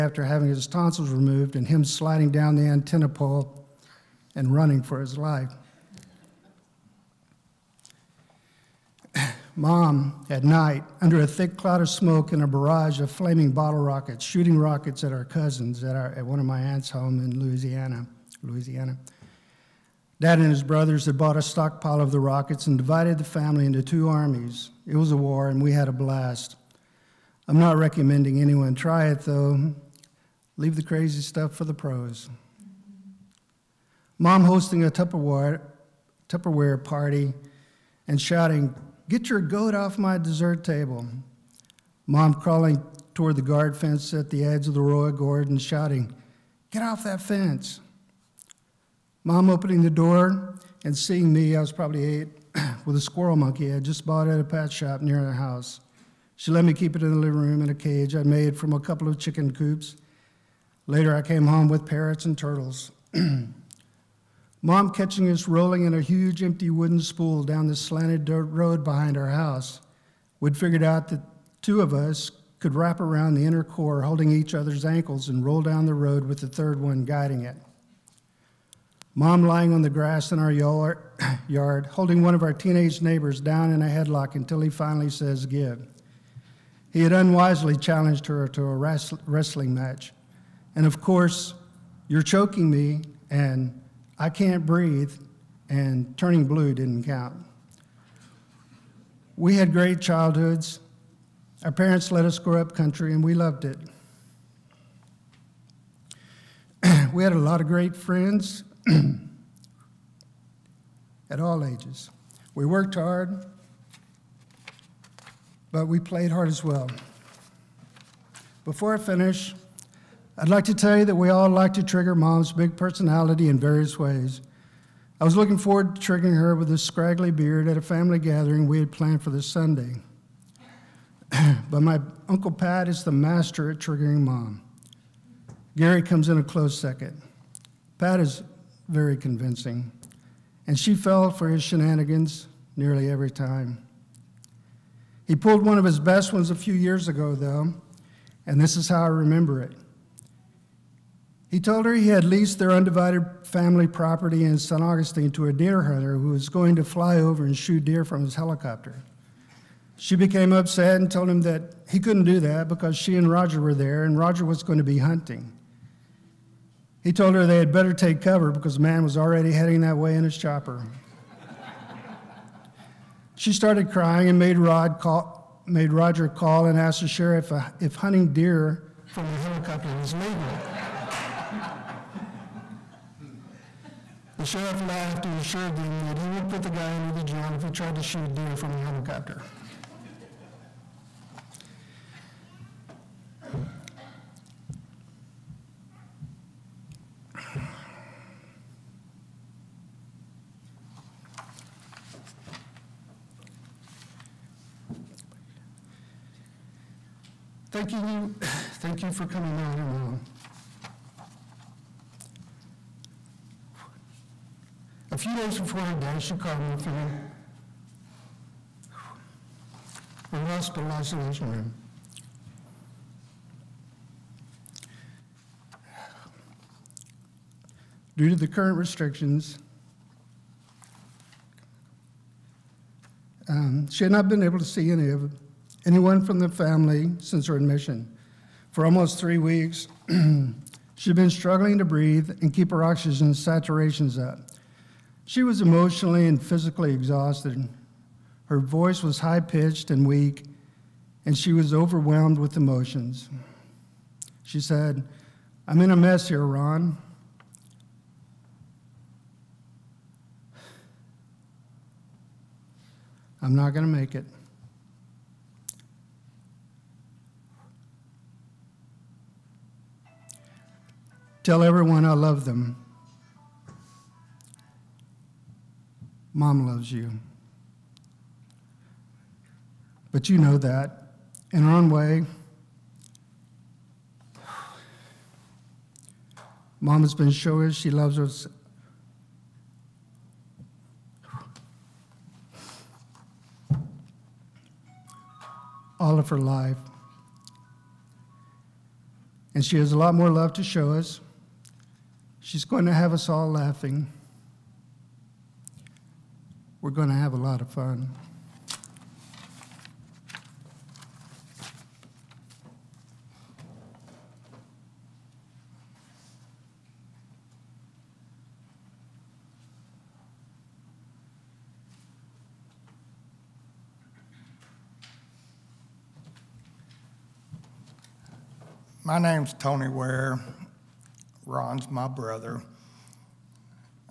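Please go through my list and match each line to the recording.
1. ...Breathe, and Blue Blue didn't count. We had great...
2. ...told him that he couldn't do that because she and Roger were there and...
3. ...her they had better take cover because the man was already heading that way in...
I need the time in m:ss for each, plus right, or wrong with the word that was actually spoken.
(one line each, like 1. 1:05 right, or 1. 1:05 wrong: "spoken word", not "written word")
1. 1:34 wrong: "Turning", not "Blue"
2. 2:41 right
3. 2:47 right.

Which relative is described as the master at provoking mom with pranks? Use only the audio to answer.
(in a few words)
Uncle Pat.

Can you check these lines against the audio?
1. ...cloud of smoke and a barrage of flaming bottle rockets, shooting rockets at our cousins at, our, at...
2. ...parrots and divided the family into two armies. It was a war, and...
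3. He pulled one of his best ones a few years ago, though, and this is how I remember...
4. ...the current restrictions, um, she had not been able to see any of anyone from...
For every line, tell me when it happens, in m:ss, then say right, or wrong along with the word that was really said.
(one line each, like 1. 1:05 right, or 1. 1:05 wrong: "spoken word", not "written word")
1. 0:11 right
2. 0:22 wrong: "rockets", not "parrots"
3. 2:25 right
4. 3:48 right.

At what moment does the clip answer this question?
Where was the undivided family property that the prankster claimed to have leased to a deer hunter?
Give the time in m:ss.
2:34.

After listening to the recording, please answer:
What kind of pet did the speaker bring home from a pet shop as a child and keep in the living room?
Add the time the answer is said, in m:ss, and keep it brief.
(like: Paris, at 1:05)
Squirrel monkey, at 0:53.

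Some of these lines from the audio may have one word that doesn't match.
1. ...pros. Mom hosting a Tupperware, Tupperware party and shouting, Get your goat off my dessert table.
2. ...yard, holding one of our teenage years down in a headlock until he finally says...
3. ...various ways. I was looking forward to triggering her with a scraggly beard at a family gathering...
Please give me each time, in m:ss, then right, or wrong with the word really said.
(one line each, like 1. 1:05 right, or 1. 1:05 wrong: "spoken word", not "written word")
1. 0:31 right
2. 1:21 wrong: "neighbors", not "years"
3. 2:03 right.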